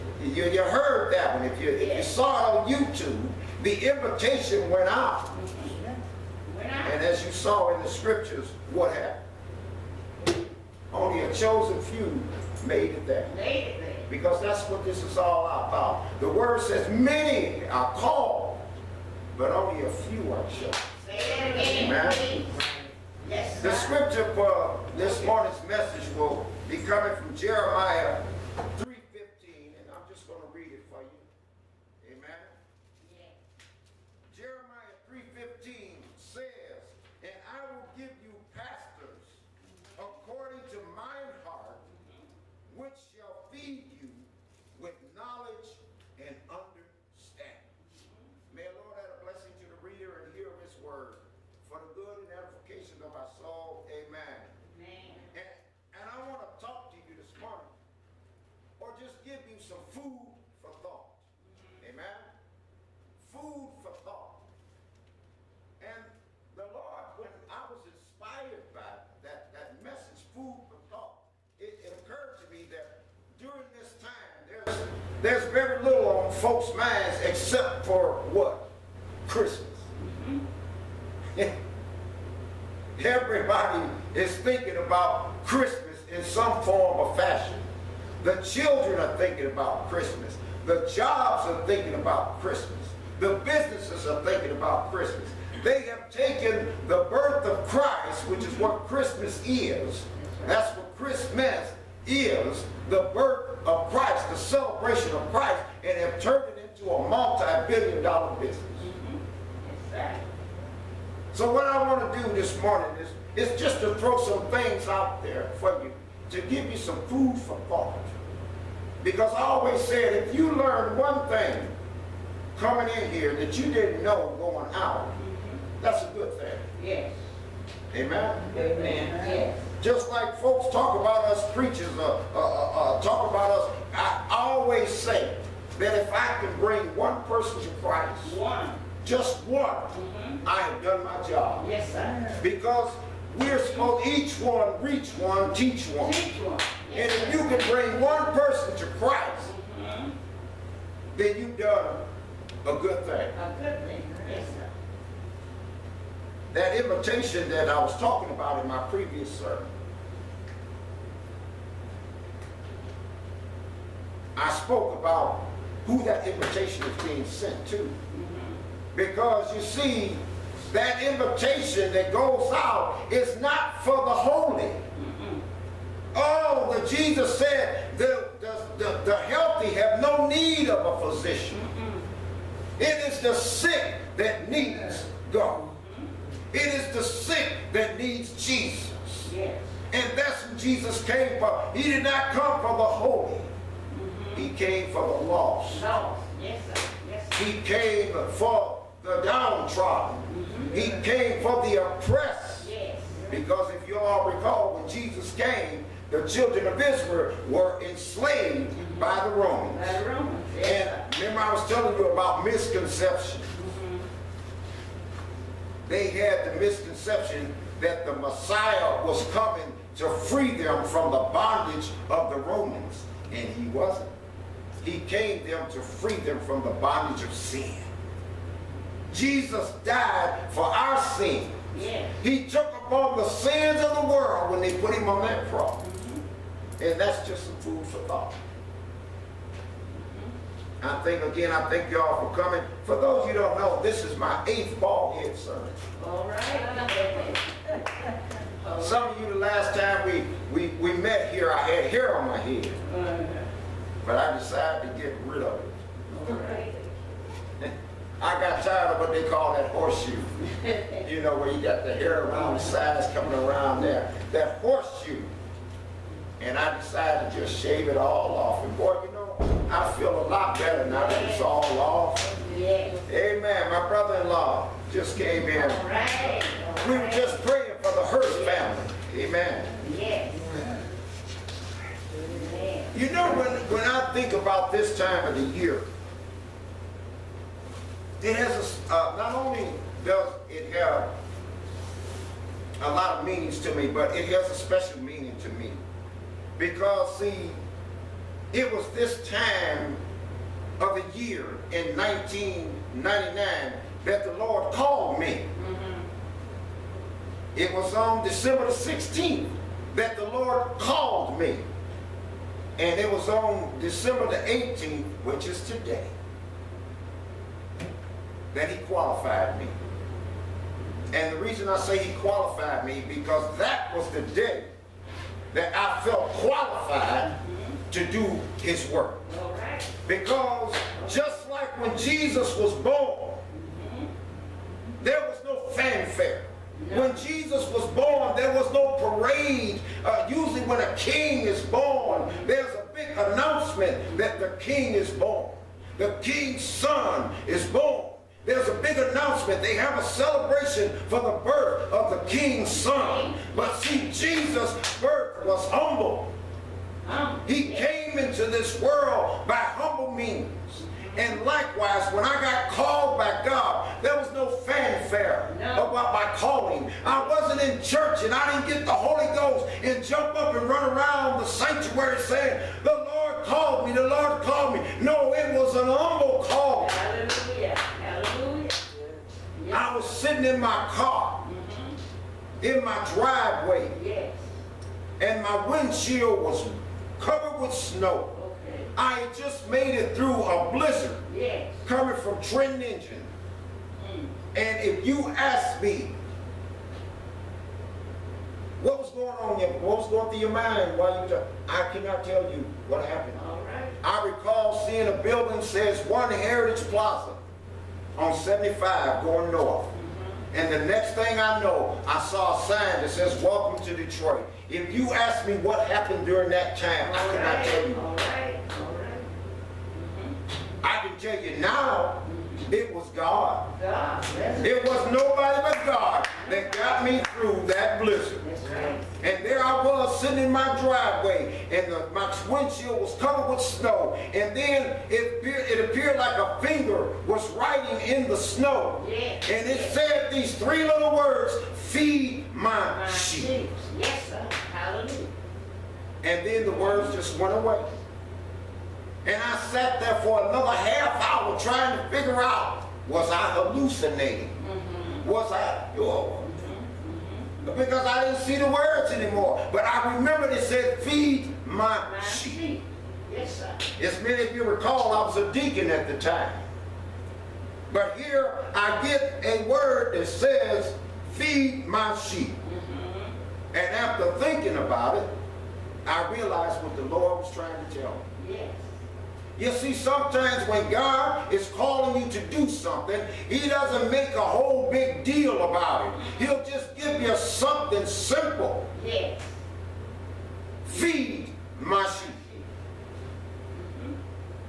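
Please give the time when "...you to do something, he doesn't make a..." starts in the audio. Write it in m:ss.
8:02.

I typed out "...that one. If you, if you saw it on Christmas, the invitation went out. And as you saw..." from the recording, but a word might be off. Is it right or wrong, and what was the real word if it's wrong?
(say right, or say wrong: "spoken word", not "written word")
wrong: "YouTube", not "Christmas".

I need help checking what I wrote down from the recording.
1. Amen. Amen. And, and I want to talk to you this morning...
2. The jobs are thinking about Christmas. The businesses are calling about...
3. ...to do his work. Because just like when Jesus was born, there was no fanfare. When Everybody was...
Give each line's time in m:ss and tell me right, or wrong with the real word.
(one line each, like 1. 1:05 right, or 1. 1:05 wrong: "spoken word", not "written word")
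1. 0:53 right
2. 1:30 wrong: "thinking", not "calling"
3. 5:27 wrong: "Jesus", not "Everybody".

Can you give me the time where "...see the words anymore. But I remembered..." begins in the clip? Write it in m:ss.
7:38.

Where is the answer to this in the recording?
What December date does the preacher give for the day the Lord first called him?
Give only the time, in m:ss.
5:08.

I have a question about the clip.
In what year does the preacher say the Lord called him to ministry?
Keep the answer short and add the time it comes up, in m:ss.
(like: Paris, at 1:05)
1999, at 5:01.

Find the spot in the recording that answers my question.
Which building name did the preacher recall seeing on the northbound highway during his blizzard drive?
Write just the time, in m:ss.
6:46.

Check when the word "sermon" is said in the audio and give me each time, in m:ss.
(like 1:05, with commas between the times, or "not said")
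2:39.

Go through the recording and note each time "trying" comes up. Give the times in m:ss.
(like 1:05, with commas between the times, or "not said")
7:31, 7:57.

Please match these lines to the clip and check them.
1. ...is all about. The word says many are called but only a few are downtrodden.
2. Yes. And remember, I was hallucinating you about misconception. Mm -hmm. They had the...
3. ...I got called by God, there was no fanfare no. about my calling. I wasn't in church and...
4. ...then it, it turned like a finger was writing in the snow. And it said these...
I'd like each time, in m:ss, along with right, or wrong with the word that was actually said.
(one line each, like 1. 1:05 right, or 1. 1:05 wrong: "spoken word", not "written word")
1. 0:15 wrong: "chosen", not "downtrodden"
2. 3:30 wrong: "telling", not "hallucinating"
3. 6:02 right
4. 7:14 wrong: "appeared", not "turned".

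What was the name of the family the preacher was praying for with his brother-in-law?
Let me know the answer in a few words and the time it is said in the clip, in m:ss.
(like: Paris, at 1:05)
Hearst, at 4:38.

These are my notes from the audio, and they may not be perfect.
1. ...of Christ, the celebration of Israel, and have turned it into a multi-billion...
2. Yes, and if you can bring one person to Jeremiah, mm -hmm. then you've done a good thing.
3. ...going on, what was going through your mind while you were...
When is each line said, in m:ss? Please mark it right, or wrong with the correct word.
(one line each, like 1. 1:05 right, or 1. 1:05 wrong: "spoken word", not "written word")
1. 1:43 wrong: "Christ", not "Israel"
2. 2:26 wrong: "Christ", not "Jeremiah"
3. 6:39 right.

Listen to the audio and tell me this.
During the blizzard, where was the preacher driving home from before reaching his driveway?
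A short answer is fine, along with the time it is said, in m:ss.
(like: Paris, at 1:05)
Trenton Engine, at 6:32.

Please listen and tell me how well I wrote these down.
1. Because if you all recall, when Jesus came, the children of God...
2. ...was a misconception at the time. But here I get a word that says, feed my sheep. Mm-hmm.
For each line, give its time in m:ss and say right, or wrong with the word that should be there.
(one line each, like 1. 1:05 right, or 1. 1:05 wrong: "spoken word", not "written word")
1. 3:23 wrong: "Israel", not "God"
2. 7:45 wrong: "deacon", not "misconception".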